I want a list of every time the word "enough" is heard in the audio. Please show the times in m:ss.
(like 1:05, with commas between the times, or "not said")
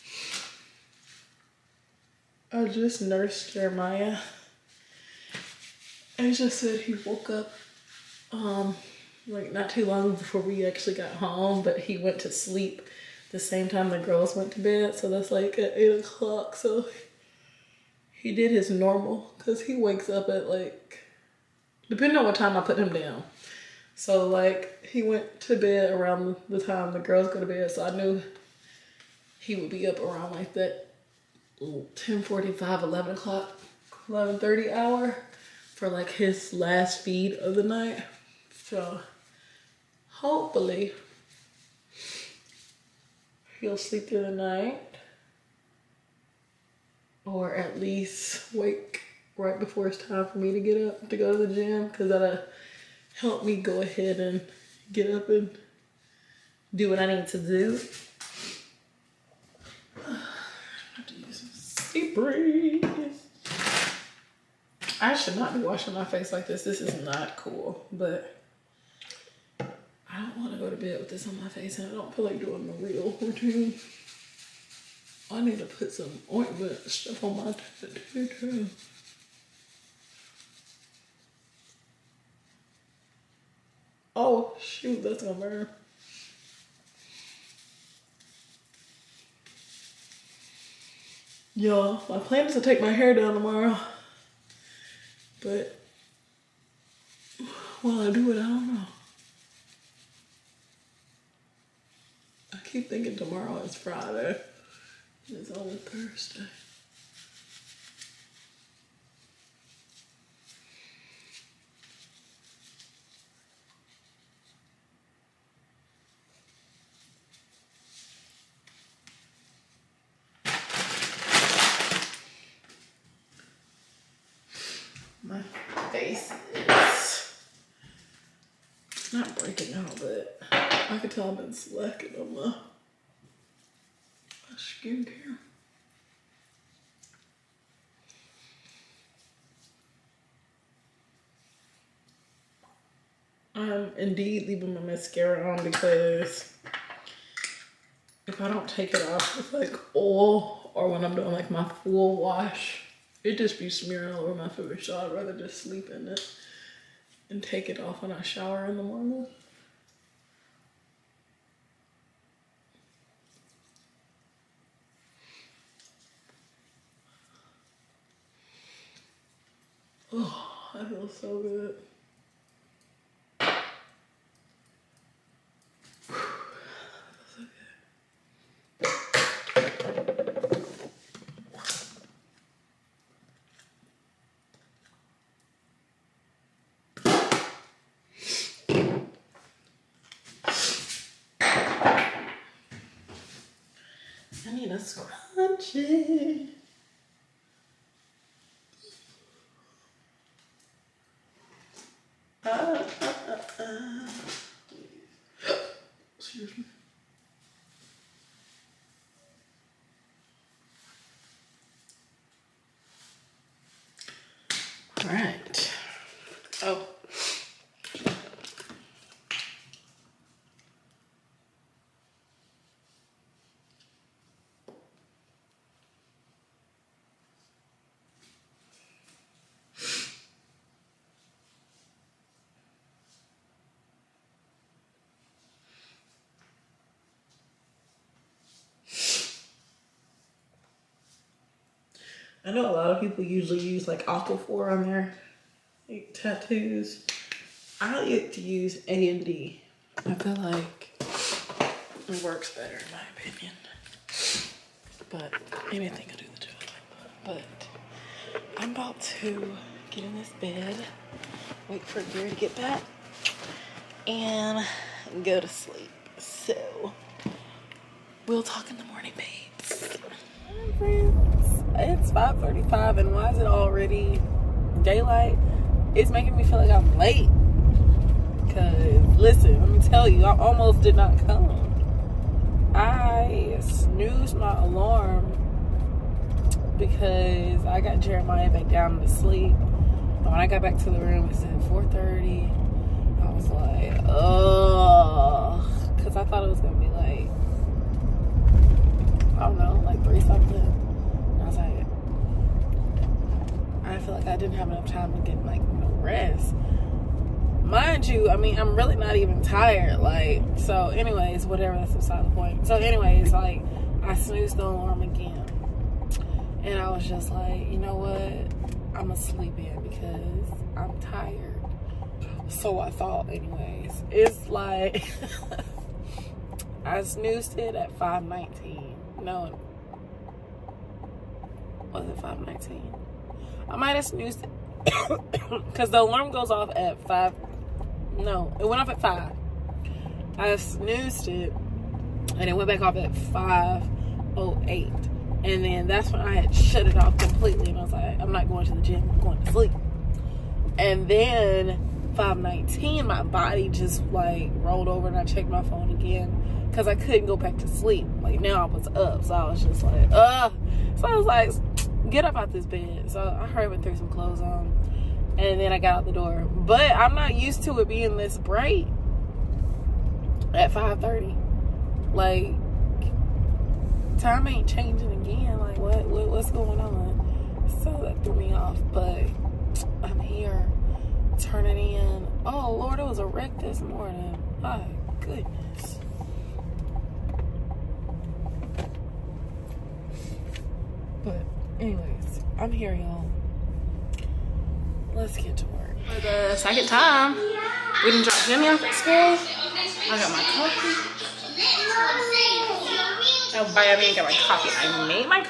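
5:04.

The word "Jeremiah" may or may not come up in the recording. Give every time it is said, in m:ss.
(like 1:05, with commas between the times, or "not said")
0:03, 4:48.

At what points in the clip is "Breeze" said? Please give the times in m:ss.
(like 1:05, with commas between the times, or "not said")
1:02.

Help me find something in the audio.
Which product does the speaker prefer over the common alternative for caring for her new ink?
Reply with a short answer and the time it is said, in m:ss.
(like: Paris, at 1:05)
A and D, at 4:08.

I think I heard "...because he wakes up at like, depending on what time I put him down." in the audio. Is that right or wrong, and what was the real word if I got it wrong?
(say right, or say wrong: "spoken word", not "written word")
right.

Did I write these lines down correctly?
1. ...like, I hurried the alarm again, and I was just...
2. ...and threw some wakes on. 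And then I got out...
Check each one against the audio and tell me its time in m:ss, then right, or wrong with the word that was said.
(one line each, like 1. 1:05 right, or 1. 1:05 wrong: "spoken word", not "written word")
1. 5:13 wrong: "snoozed", not "hurried"
2. 6:03 wrong: "clothes", not "wakes".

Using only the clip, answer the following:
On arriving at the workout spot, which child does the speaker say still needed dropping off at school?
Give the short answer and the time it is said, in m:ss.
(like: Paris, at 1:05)
Jimmy, at 6:38.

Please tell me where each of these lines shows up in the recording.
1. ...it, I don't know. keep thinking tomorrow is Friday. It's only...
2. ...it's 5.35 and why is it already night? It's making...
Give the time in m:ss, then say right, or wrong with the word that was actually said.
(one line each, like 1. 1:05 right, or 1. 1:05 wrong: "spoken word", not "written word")
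1. 1:38 right
2. 4:31 wrong: "daylight", not "night".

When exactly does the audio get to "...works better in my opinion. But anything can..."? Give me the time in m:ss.
4:12.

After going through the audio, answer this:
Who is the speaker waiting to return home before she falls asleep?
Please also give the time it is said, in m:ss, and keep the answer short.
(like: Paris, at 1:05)
Gary, at 4:22.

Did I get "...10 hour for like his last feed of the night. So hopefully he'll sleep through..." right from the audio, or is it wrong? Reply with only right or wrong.
wrong.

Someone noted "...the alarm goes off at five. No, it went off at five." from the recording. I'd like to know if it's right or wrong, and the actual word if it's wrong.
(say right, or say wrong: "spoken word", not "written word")
right.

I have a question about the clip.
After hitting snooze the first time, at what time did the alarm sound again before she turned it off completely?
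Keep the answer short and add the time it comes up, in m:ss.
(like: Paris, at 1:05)
5:08, at 5:43.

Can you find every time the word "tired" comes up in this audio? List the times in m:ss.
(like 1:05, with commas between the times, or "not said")
5:09, 5:21.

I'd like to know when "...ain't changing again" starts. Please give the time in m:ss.
6:14.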